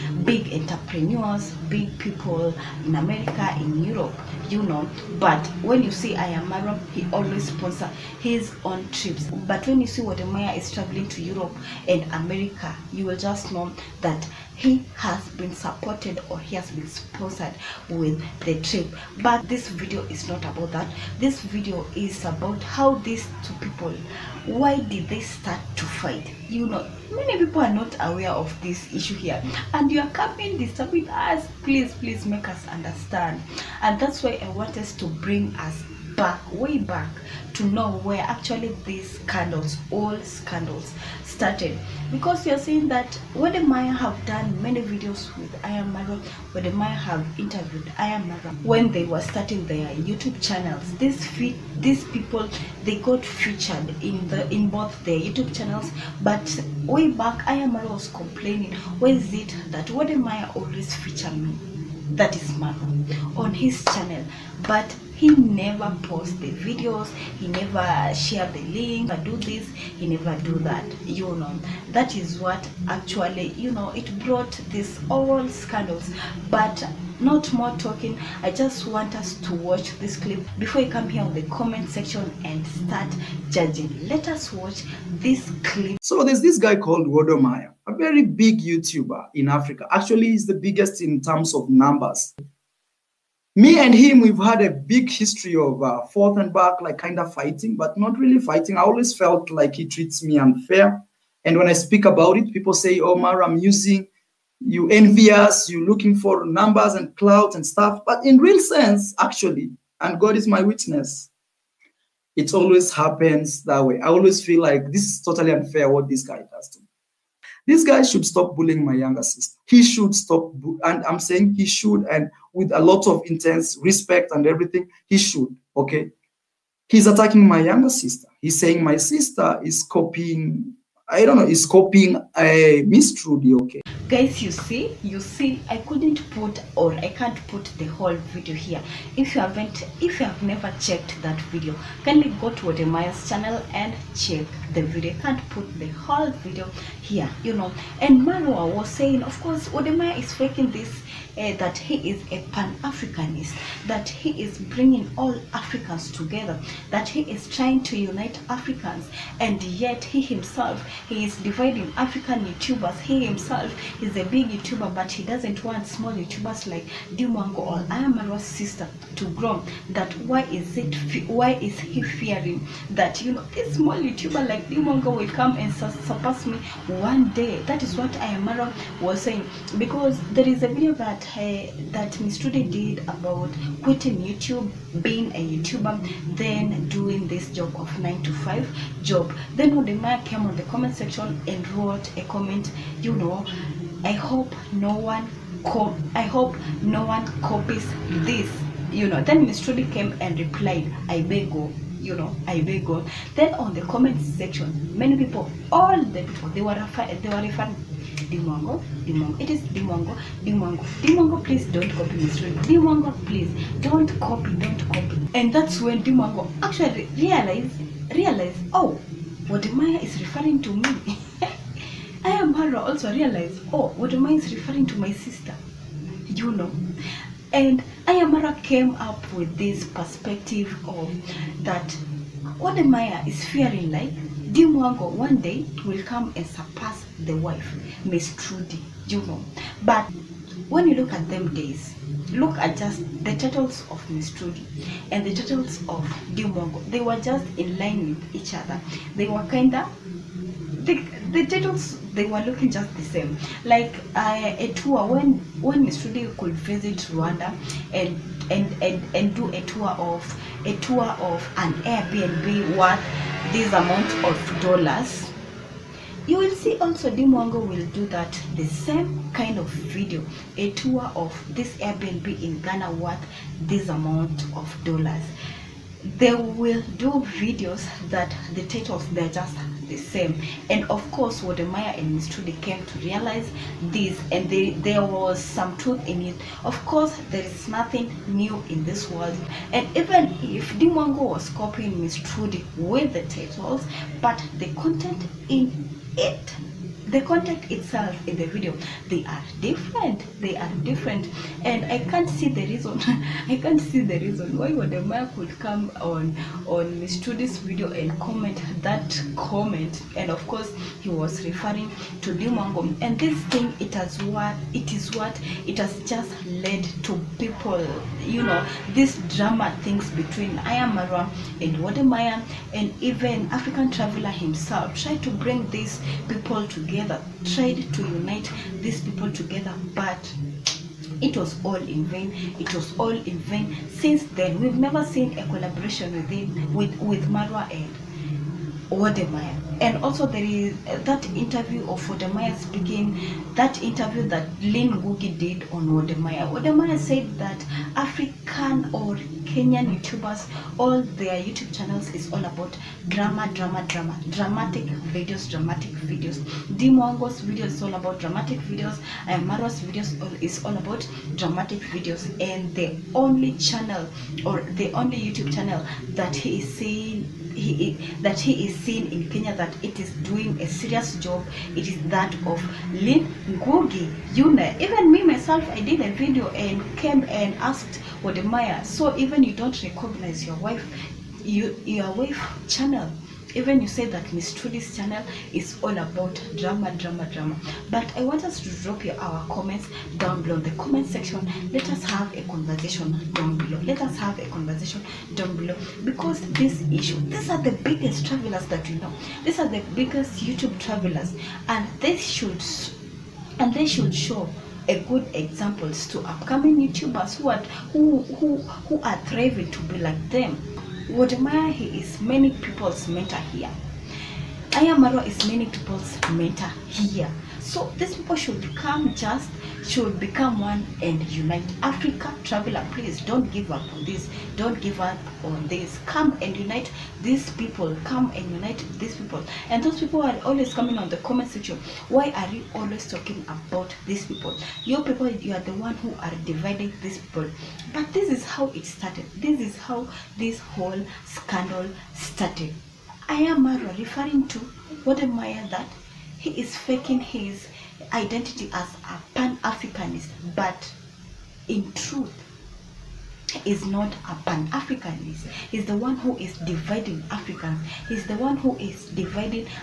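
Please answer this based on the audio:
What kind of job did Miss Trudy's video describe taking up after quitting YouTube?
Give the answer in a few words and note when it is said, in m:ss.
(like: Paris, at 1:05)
9 to 5 job, at 3:07.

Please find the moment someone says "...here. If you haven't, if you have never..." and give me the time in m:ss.
2:18.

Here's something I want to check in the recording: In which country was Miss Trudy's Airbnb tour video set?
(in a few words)
Rwanda.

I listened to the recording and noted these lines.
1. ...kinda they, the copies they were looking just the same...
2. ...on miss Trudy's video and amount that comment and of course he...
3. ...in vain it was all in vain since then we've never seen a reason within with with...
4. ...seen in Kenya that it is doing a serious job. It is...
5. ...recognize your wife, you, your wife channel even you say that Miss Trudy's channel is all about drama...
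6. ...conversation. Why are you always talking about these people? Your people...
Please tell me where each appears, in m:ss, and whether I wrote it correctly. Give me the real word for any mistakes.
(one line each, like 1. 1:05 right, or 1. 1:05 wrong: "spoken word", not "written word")
1. 4:09 wrong: "titles", not "copies"
2. 5:06 wrong: "comment", not "amount"
3. 5:31 wrong: "collaboration", not "reason"
4. 6:08 right
5. 6:19 right
6. 7:11 wrong: "section", not "conversation".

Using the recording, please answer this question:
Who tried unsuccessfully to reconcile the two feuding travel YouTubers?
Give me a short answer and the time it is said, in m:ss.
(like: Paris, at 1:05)
African traveler, at 5:23.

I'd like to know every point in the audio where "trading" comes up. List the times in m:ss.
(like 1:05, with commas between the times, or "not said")
not said.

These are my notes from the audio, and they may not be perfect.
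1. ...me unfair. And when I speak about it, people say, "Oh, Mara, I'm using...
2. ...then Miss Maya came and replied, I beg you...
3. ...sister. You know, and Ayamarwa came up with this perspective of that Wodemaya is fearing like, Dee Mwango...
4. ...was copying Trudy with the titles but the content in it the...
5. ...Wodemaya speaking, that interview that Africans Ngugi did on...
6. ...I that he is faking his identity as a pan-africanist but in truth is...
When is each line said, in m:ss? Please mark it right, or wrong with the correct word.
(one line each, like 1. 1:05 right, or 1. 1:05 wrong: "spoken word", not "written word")
1. 1:40 right
2. 3:19 wrong: "Trudy", not "Maya"
3. 3:45 right
4. 4:51 right
5. 5:42 wrong: "Lynn", not "Africans"
6. 7:25 right.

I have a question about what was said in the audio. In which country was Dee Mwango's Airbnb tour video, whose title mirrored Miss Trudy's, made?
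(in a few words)
Ghana.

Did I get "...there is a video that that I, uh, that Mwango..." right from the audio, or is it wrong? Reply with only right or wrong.
wrong.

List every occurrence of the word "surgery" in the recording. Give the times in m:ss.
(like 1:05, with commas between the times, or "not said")
not said.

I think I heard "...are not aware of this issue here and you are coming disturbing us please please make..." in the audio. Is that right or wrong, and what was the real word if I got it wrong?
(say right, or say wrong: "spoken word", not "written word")
right.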